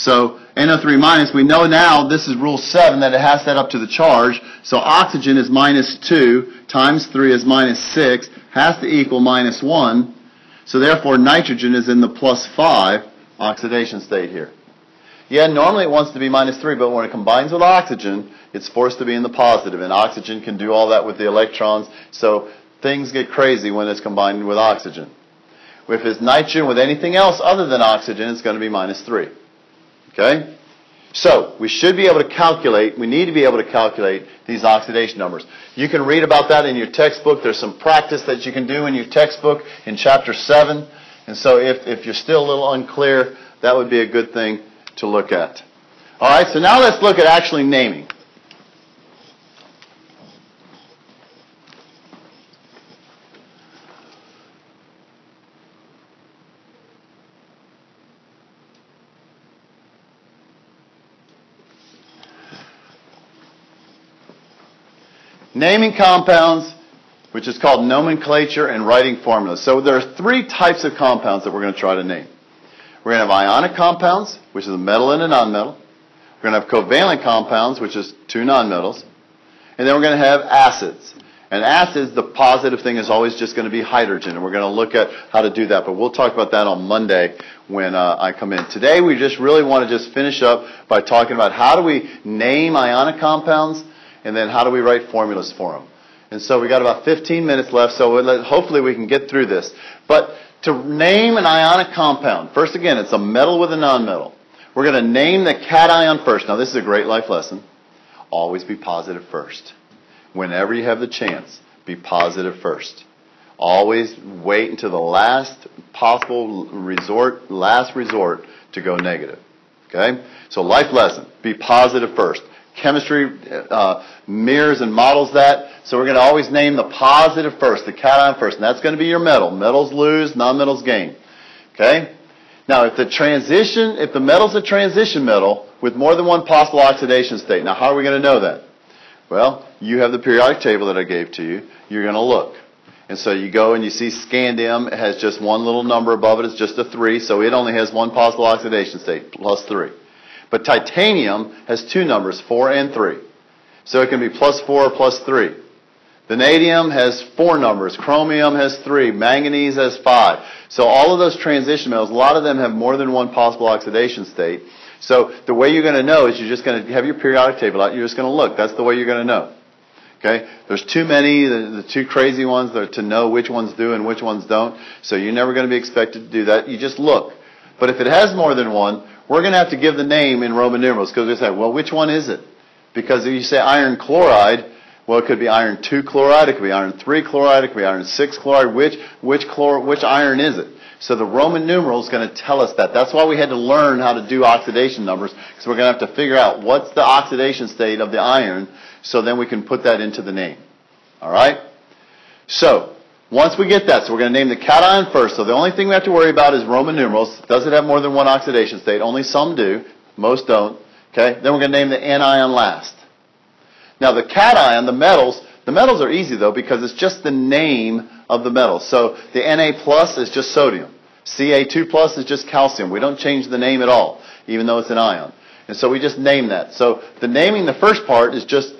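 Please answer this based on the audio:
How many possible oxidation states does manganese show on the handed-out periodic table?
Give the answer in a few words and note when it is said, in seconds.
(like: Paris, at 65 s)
5, at 159 s.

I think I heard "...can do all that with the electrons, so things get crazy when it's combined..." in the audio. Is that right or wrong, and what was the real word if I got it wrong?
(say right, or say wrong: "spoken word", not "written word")
right.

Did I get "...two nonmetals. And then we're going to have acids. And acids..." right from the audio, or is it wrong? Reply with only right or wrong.
right.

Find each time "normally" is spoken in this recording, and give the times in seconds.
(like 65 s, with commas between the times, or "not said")
15 s.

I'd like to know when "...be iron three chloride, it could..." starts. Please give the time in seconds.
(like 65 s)
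186 s.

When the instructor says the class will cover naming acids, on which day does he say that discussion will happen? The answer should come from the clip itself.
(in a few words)
Monday.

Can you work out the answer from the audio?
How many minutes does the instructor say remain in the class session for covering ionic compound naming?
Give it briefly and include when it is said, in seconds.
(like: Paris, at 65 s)
15, at 97 s.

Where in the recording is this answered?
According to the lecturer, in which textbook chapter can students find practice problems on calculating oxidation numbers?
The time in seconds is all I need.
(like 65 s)
39 s.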